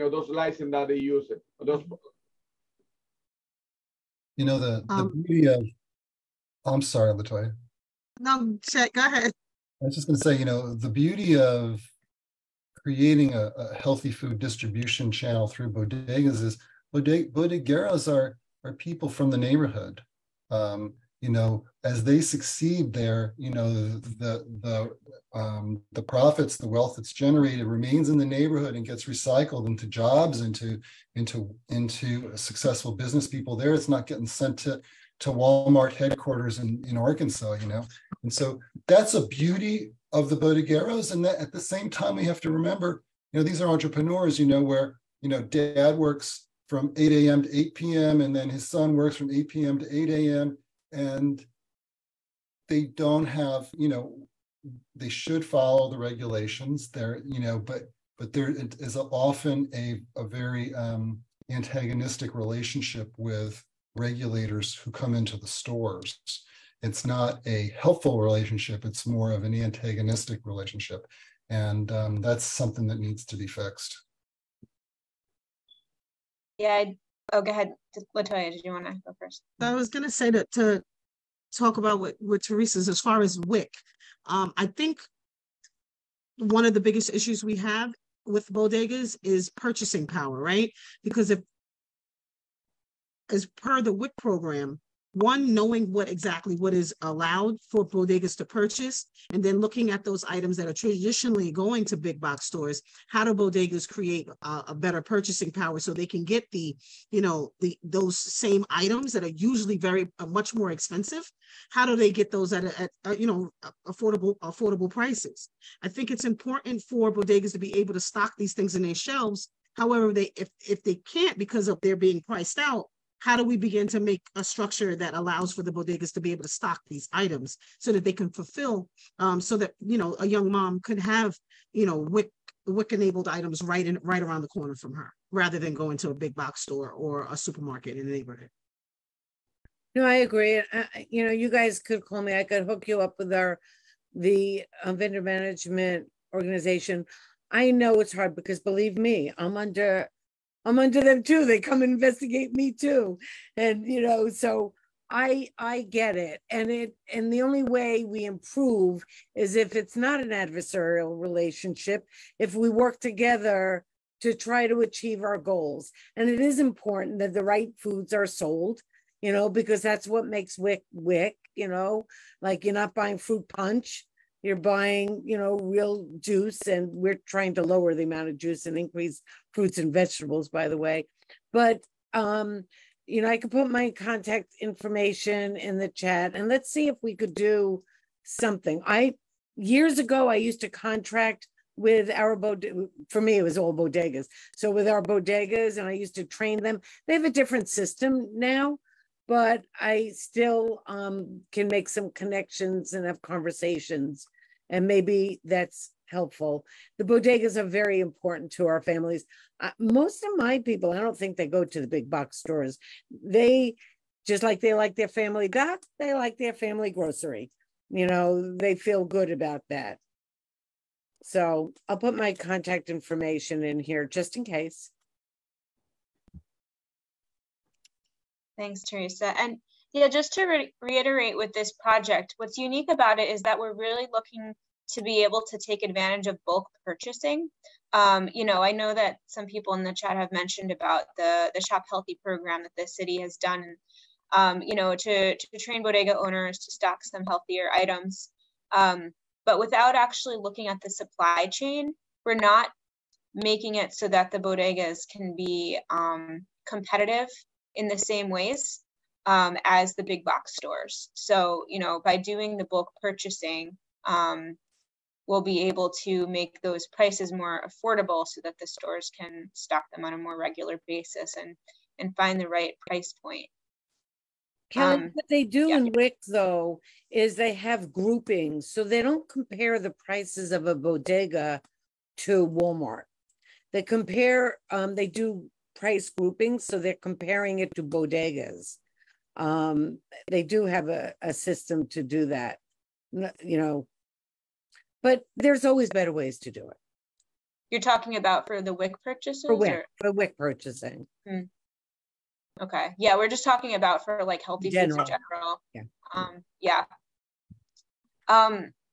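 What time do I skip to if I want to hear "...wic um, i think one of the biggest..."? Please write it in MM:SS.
01:23.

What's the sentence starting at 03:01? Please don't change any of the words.
But um, you know, I could put my contact information in the chat and let's see if we could do something.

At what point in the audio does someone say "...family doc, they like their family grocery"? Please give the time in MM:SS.
03:35.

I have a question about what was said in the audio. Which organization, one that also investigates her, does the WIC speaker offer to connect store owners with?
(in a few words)
vendor management organization.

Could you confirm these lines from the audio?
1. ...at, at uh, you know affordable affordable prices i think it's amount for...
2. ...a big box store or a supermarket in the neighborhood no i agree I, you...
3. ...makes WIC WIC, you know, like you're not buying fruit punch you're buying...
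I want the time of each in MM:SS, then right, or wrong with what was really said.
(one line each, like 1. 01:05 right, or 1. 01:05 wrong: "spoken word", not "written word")
1. 01:52 wrong: "important", not "amount"
2. 02:16 right
3. 02:50 right.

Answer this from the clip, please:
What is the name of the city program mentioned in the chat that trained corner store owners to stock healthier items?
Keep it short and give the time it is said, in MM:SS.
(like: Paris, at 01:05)
Shop Healthy, at 04:01.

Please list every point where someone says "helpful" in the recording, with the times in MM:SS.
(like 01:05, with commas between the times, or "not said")
01:07, 03:26.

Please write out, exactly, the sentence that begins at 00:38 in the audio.
And so that's a beauty of the bodegueros.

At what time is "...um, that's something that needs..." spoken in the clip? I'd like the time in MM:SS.
01:11.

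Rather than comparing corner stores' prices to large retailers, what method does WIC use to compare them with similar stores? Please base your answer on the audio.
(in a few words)
price groupings.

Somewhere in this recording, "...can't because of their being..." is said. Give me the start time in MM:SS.
02:00.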